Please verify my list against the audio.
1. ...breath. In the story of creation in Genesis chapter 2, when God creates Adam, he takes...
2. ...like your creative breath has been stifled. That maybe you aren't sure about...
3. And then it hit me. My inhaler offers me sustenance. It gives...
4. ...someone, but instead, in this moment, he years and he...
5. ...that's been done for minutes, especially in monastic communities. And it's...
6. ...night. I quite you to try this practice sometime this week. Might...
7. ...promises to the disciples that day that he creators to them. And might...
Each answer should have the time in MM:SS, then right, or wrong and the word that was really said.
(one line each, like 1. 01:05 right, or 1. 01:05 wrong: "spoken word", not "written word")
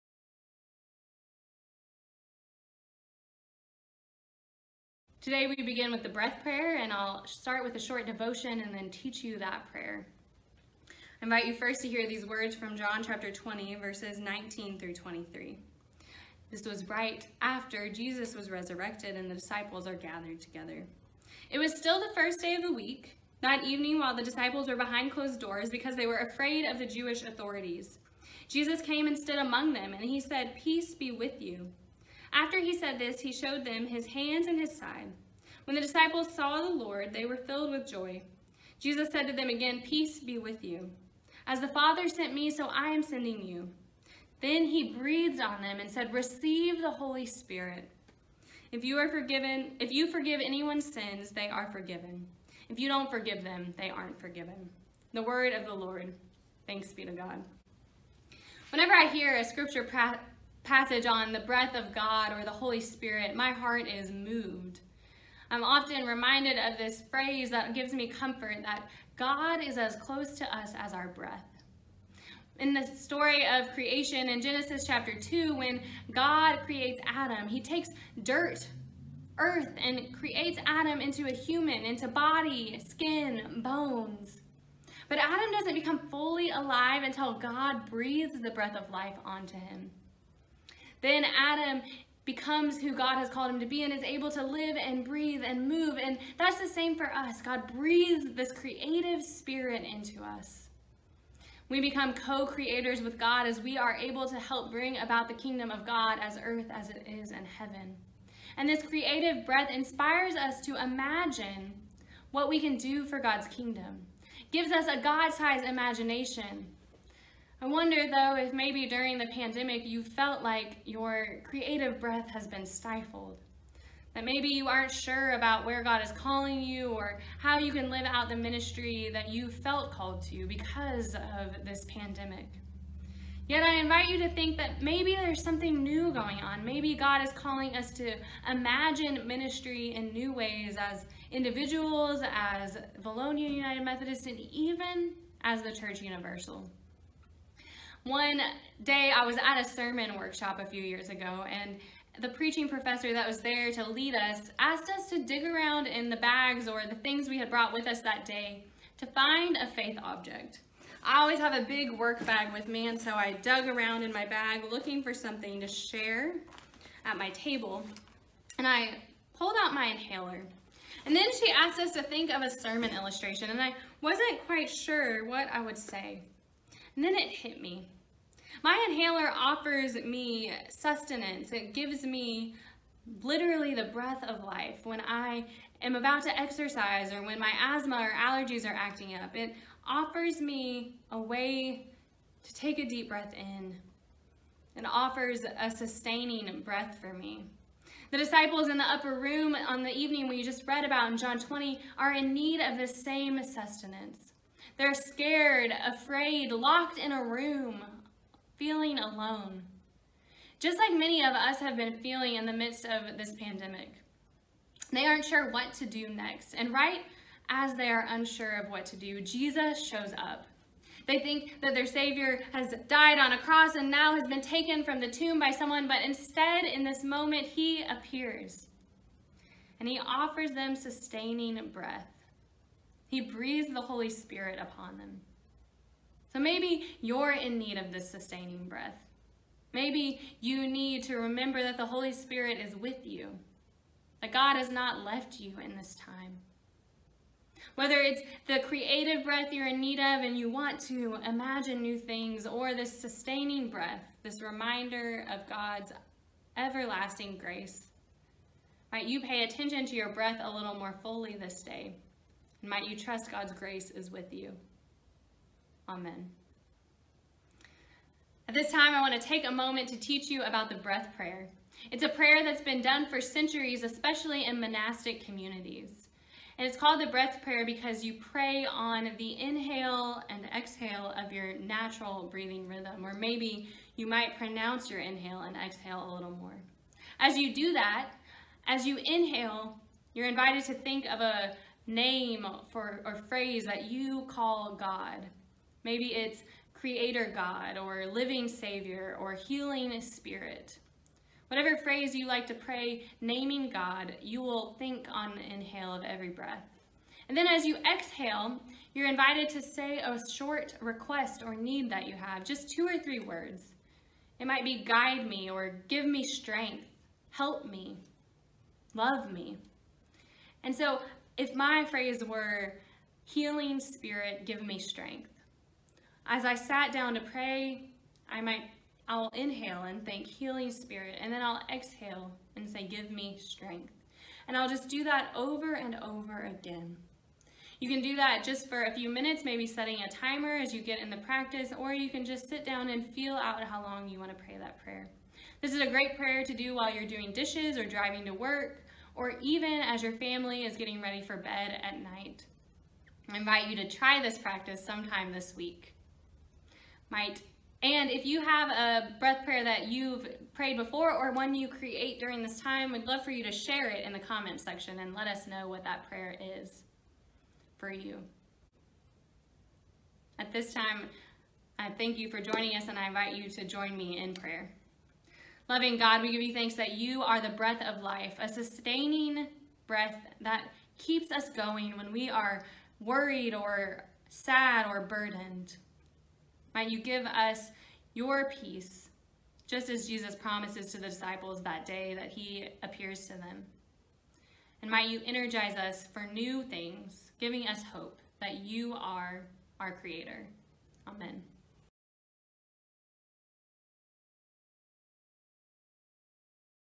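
1. 01:11 right
2. 02:00 right
3. 02:56 right
4. 03:45 wrong: "appears", not "years"
5. 04:32 wrong: "centuries", not "minutes"
6. 05:52 wrong: "invite", not "quite"
7. 06:30 wrong: "appears", not "creators".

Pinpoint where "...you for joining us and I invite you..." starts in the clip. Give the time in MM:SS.
06:12.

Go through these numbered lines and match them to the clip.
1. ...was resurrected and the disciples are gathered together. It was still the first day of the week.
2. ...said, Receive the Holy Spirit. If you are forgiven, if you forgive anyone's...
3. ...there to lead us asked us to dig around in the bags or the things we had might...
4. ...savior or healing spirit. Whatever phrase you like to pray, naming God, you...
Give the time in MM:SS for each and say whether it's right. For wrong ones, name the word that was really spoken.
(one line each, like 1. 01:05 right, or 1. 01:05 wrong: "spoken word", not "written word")
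1. 00:18 right
2. 00:45 right
3. 02:33 wrong: "brought", not "might"
4. 04:58 right.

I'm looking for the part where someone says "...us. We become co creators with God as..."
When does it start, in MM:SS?
01:40.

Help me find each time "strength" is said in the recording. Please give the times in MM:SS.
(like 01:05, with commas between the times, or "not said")
05:16, 05:24, 05:33.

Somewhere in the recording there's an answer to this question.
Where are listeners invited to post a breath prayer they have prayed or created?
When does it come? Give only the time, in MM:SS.
06:04.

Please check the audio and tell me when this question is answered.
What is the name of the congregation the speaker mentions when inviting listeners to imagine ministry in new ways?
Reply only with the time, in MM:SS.
02:23.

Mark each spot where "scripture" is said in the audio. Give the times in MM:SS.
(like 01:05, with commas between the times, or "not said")
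00:59.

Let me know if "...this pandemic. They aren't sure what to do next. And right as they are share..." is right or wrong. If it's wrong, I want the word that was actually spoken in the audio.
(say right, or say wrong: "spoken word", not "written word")
wrong: "unsure", not "share".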